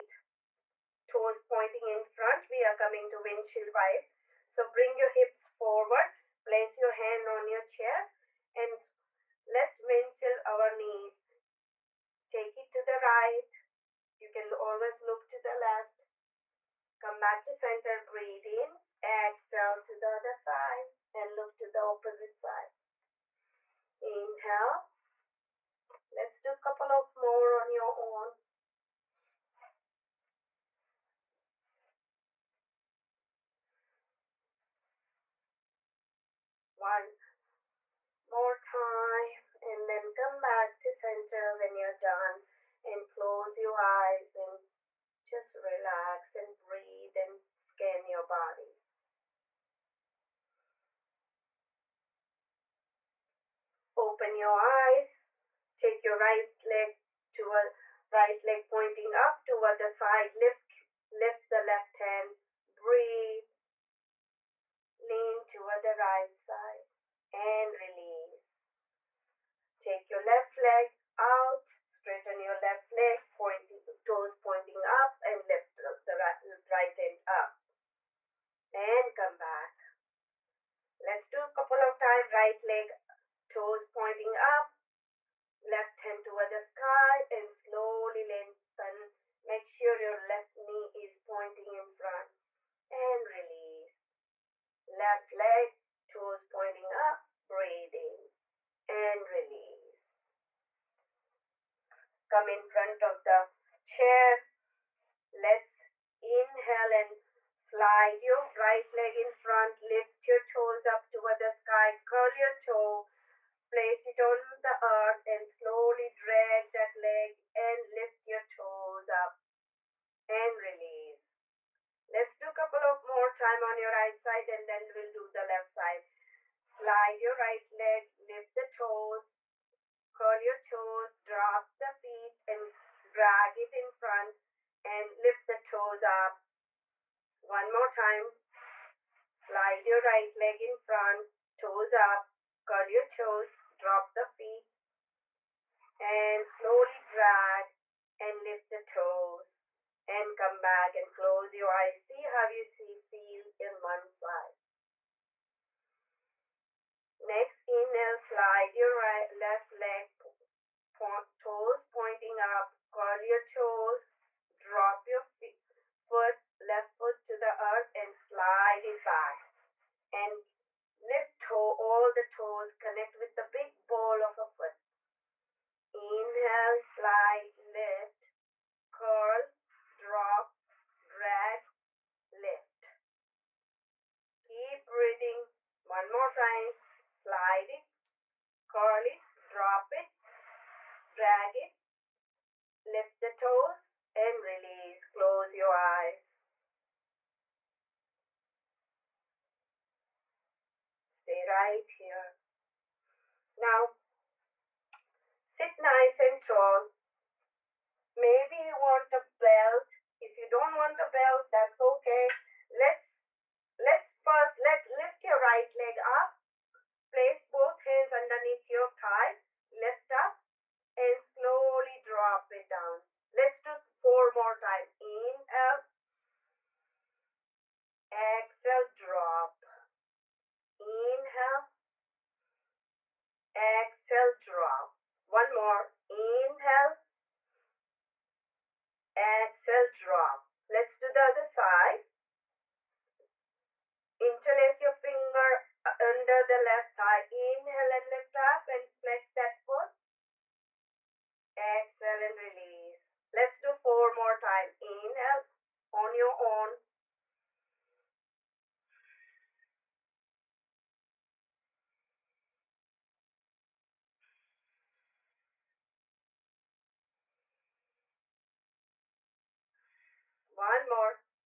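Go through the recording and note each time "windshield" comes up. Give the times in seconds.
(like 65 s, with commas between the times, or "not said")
3 s, 9 s.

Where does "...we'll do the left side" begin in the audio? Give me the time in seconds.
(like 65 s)
124 s.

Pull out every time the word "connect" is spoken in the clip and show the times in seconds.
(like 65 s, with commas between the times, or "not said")
172 s.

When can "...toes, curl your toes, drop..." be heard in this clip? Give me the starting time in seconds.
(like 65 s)
128 s.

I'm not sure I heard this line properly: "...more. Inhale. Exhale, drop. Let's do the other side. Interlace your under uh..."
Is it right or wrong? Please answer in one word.
wrong.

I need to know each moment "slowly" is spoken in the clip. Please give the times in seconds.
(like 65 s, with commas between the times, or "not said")
87 s, 115 s, 146 s, 221 s.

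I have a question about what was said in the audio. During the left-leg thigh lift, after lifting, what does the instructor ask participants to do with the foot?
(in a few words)
flex that foot.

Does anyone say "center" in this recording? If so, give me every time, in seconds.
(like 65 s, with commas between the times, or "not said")
17 s, 40 s.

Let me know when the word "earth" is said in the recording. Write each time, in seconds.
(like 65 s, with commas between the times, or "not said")
114 s, 167 s.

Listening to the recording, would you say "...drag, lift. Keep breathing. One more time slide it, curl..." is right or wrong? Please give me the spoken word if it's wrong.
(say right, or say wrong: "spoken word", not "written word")
right.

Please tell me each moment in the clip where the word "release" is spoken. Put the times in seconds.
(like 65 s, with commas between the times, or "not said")
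67 s, 93 s, 99 s, 120 s, 194 s, 252 s.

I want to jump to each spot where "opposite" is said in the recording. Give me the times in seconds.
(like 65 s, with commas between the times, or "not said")
21 s.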